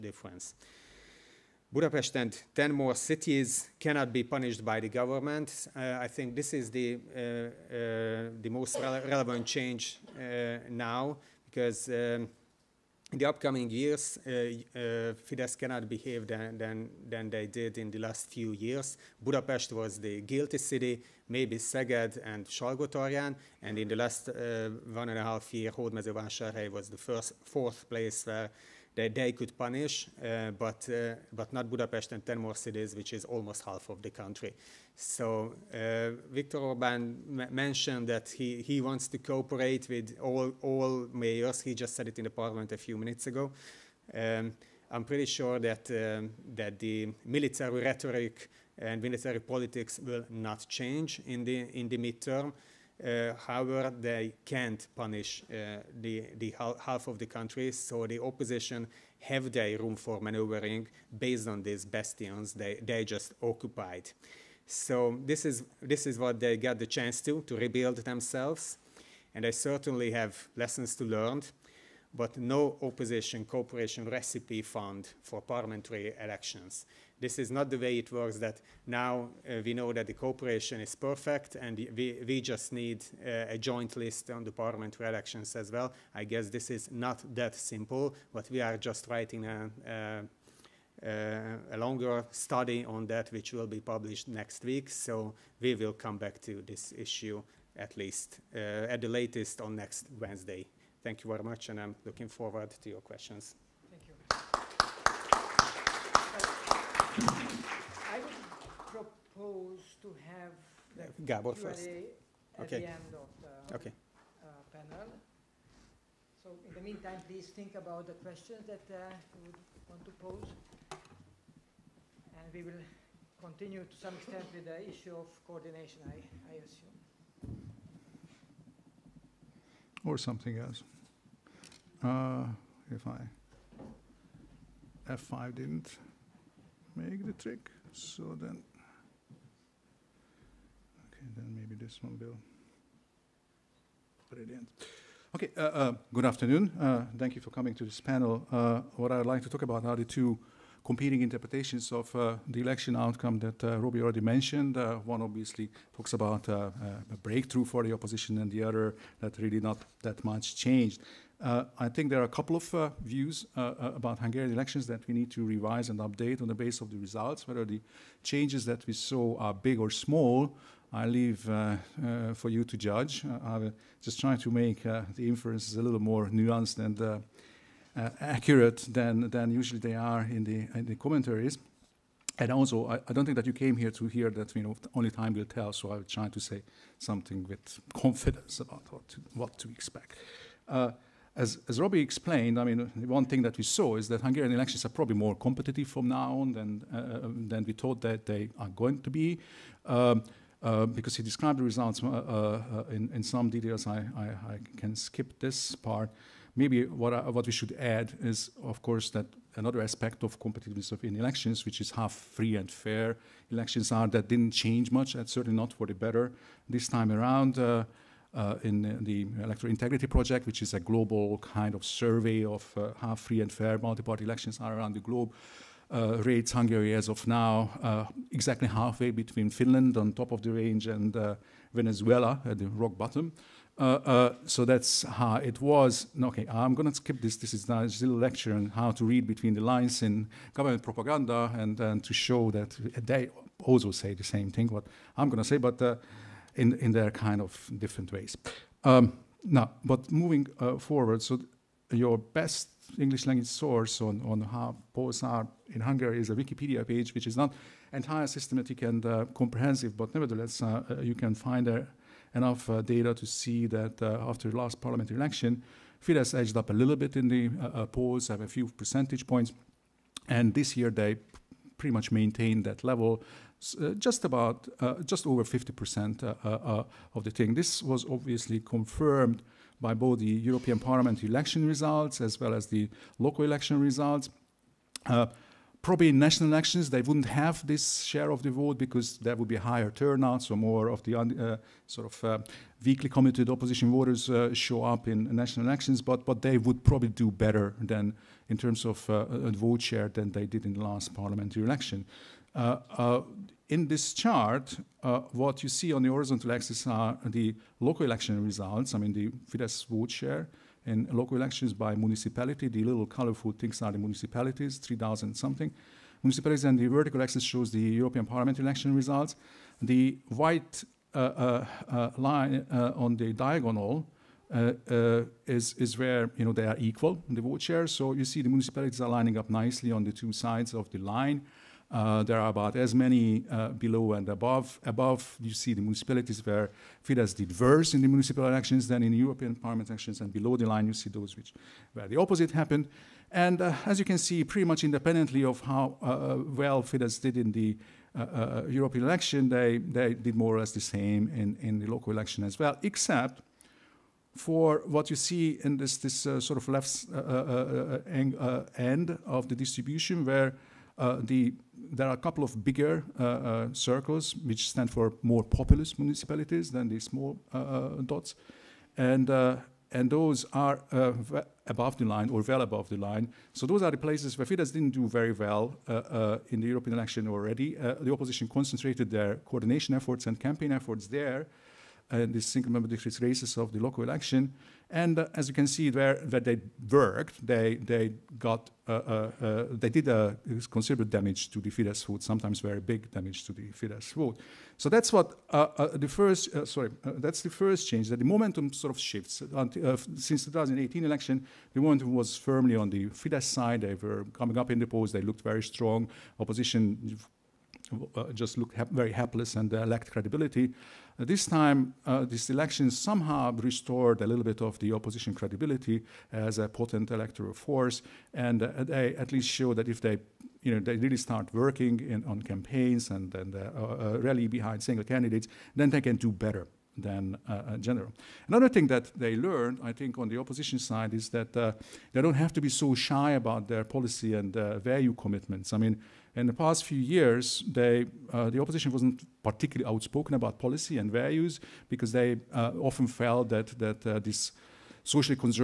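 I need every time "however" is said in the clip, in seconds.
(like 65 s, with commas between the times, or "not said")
53 s.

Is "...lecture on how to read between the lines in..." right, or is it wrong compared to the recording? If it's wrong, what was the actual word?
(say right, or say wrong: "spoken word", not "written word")
right.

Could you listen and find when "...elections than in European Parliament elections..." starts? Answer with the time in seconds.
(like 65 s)
338 s.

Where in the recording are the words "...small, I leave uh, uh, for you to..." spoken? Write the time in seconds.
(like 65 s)
169 s.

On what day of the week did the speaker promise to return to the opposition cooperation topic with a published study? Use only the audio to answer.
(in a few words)
Wednesday.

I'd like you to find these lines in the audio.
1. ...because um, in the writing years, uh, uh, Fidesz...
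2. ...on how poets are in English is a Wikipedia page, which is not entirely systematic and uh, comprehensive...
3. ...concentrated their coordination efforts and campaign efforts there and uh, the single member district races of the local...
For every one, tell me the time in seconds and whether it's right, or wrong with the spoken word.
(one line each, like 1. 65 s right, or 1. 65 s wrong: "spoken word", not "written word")
1. 11 s wrong: "upcoming", not "writing"
2. 254 s wrong: "Hungary", not "English"
3. 378 s right.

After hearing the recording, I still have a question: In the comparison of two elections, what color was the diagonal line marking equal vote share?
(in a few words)
White.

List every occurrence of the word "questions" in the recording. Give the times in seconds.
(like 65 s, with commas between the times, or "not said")
102 s, 118 s.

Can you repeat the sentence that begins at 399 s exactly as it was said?
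Until, since the 2018 election, the momentum was firmly on the Fidesz side.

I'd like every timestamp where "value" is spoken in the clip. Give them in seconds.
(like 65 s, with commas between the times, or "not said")
434 s, 441 s.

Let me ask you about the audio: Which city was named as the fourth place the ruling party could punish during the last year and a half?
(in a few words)
Hódmezővásárhely.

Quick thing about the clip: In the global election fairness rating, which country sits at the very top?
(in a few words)
Finland.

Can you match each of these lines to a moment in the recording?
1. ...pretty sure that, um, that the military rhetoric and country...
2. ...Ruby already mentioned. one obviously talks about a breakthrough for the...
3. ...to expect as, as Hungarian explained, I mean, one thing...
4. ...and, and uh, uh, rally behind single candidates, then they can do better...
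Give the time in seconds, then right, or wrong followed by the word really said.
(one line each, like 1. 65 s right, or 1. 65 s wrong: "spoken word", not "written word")
1. 45 s wrong: "military", not "country"
2. 153 s right
3. 189 s wrong: "Robbie", not "Hungarian"
4. 423 s right.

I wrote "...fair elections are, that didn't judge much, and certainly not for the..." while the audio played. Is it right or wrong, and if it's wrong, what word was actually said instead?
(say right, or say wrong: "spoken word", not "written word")
wrong: "change", not "judge".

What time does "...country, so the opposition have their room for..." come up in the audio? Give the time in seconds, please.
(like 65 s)
57 s.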